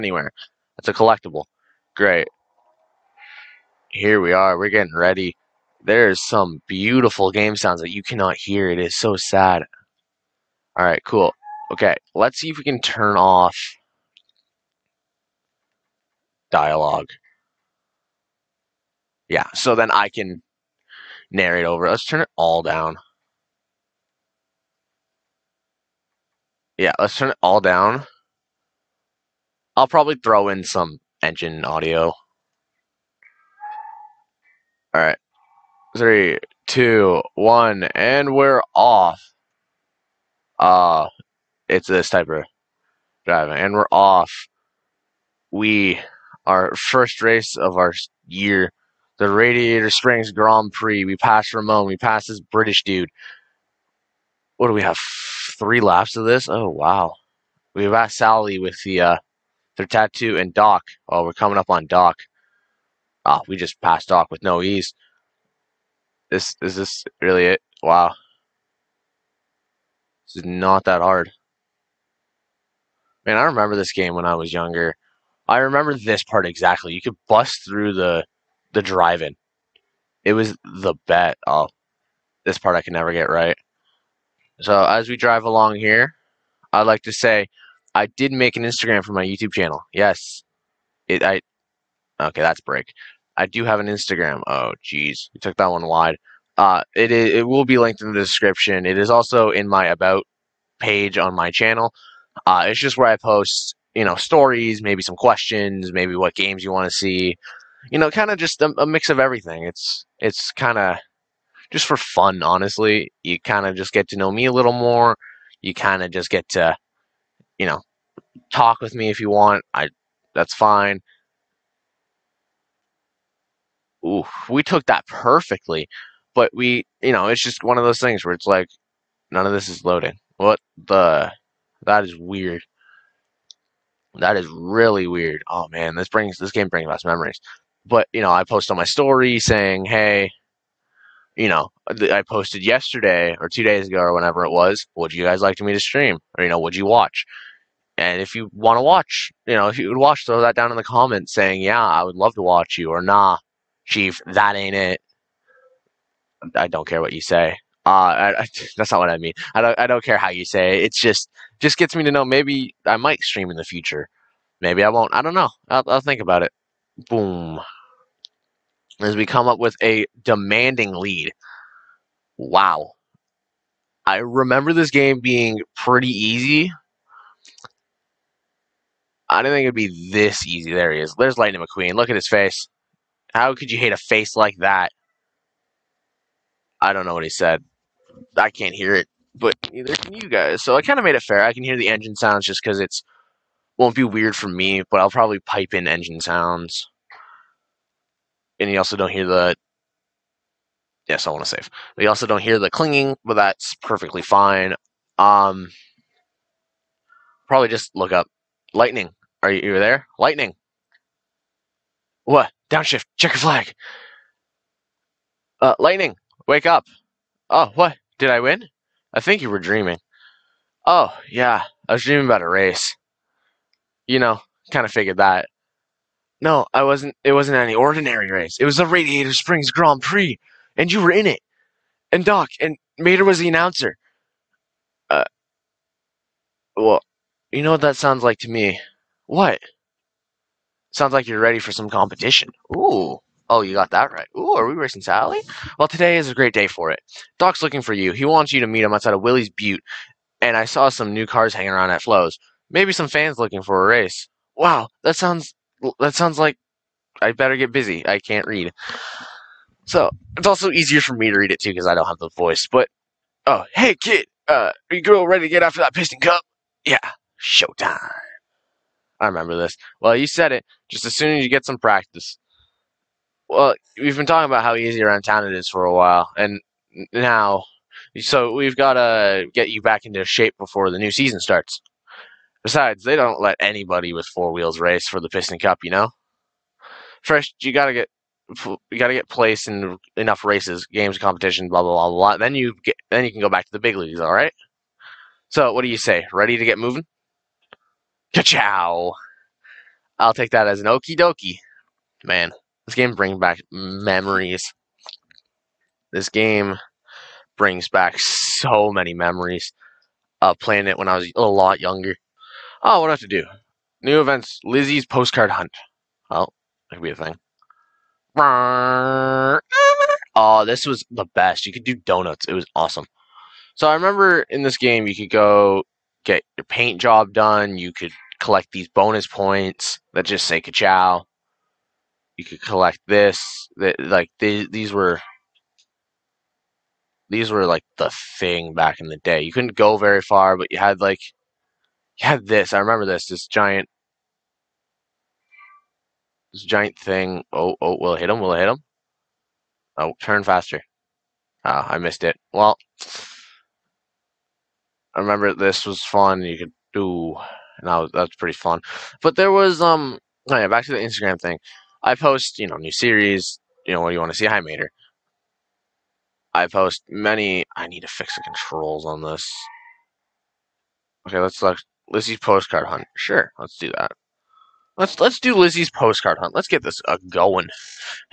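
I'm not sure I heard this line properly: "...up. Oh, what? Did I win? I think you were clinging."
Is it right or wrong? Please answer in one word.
wrong.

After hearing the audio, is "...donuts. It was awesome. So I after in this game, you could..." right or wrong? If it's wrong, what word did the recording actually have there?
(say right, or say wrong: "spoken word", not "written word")
wrong: "remember", not "after".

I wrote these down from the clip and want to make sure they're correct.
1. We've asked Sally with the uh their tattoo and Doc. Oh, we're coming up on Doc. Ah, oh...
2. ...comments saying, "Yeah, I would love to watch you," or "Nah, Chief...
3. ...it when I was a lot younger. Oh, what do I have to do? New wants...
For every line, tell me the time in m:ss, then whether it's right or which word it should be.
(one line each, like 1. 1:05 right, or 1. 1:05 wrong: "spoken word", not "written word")
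1. 0:57 right
2. 2:30 right
3. 5:10 wrong: "events", not "wants".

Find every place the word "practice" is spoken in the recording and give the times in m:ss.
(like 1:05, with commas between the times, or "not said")
4:31.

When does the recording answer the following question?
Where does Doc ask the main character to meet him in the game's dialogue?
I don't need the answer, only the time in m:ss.
4:09.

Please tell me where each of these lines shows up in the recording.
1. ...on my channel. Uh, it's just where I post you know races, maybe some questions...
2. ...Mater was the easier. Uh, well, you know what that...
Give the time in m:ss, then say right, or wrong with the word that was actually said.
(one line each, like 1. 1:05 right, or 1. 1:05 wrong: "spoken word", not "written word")
1. 1:41 wrong: "stories", not "races"
2. 3:52 wrong: "announcer", not "easier".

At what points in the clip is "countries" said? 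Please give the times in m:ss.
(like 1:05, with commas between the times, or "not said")
not said.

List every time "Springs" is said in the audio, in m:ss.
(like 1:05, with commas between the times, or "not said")
0:49, 3:49.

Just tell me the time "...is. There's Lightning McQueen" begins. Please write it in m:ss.
3:01.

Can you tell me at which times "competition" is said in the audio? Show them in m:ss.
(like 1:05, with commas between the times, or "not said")
4:01, 4:51.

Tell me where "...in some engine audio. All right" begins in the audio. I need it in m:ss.
0:30.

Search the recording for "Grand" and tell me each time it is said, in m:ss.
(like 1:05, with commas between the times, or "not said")
0:50, 3:49.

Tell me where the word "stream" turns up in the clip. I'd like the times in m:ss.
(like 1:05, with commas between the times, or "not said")
2:25, 2:43.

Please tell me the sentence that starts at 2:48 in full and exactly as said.
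As we come up with a demanding lead.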